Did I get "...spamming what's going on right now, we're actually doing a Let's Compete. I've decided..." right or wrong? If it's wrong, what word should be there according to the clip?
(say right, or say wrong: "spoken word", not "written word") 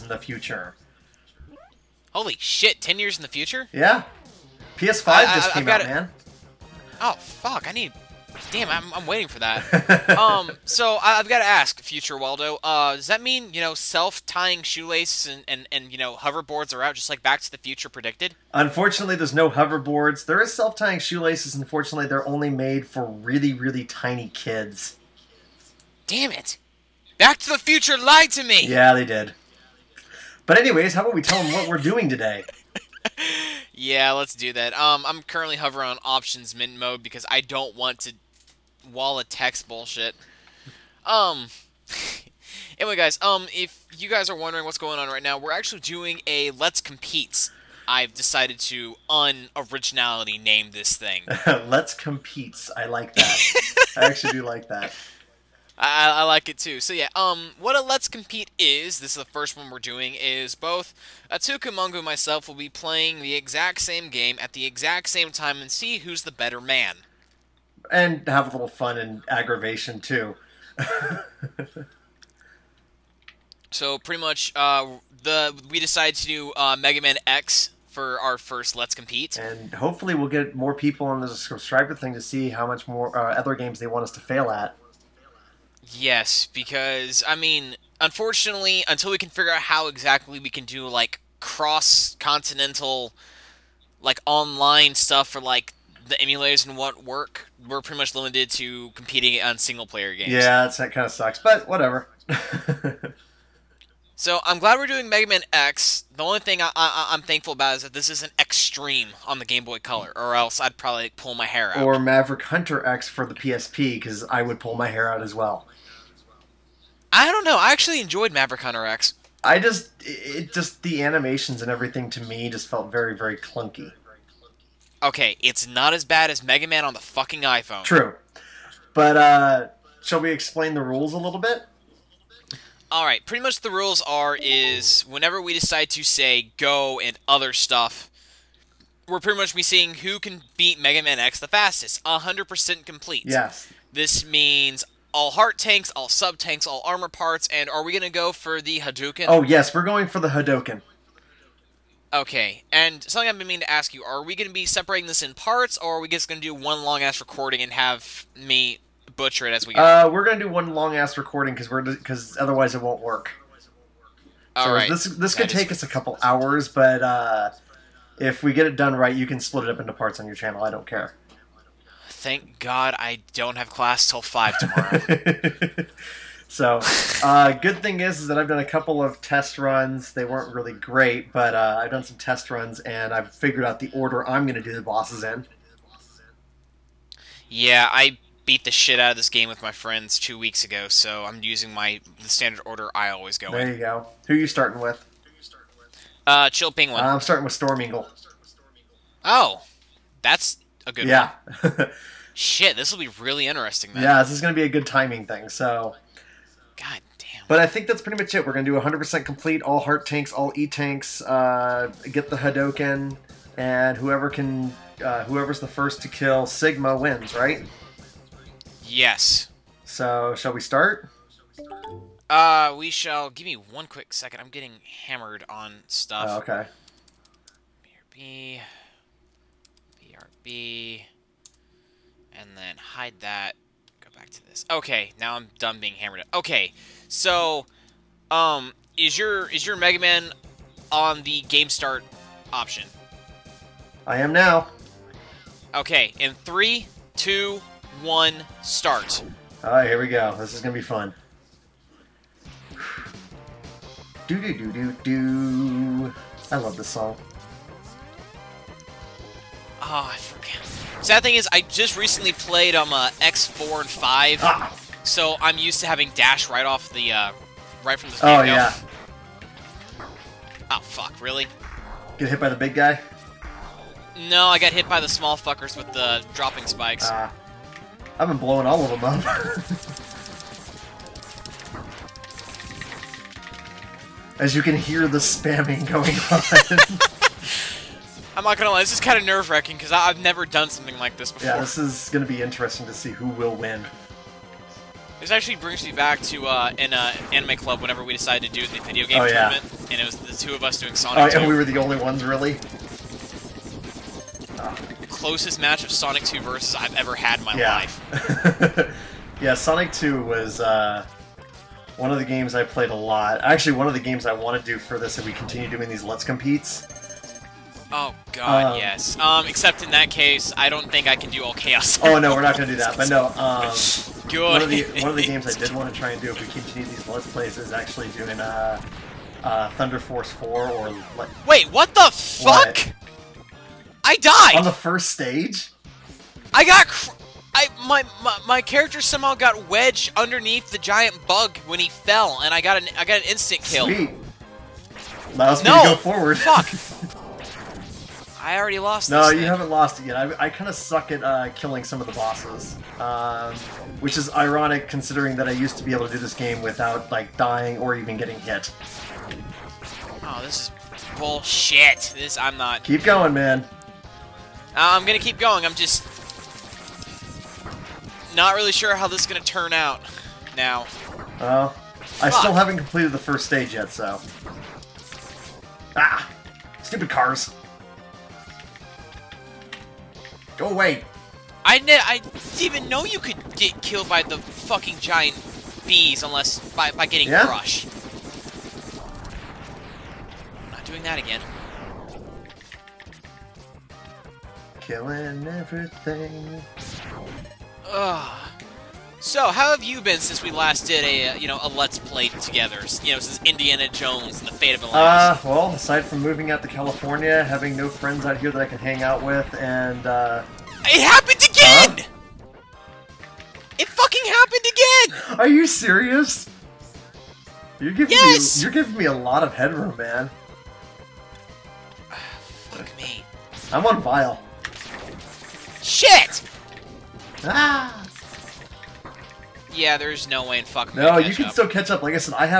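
wrong: "wondering", not "spamming".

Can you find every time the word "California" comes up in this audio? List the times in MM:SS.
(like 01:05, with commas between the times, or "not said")
06:46.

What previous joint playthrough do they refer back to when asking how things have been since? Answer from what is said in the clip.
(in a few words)
Indiana Jones and the Fate of the Atlantis.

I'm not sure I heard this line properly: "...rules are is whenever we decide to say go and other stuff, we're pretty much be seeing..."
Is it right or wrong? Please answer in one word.
right.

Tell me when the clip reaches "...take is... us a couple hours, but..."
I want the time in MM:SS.
02:45.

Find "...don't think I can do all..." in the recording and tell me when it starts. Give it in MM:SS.
05:20.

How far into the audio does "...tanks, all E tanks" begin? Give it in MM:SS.
03:30.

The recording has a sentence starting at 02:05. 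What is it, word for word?
Okay, it's not as bad as Mega Man on the fucking iPhone.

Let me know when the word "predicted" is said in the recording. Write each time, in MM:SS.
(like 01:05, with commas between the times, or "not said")
00:17.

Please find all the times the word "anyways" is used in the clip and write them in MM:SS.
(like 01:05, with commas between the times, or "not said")
00:30, 00:42.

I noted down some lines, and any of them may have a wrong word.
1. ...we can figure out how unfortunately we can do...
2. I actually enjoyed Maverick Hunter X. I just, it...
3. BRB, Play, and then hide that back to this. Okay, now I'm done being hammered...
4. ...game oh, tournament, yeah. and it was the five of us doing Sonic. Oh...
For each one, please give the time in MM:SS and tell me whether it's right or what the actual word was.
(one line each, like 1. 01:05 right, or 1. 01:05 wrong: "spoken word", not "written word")
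1. 01:29 wrong: "exactly", not "unfortunately"
2. 01:57 right
3. 03:48 wrong: "BRB", not "Play"
4. 04:59 wrong: "two", not "five".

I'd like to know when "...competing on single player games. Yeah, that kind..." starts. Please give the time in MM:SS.
01:38.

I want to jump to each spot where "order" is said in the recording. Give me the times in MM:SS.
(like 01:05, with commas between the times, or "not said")
03:03, 03:12.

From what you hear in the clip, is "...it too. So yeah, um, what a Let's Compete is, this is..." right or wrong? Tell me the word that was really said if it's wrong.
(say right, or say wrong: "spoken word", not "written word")
right.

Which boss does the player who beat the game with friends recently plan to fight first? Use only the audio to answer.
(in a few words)
Chill Penguin.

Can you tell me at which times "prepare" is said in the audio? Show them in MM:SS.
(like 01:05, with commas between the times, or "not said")
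not said.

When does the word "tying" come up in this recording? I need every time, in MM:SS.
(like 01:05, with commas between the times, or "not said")
00:14, 00:20.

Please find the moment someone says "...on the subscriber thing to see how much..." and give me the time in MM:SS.
01:21.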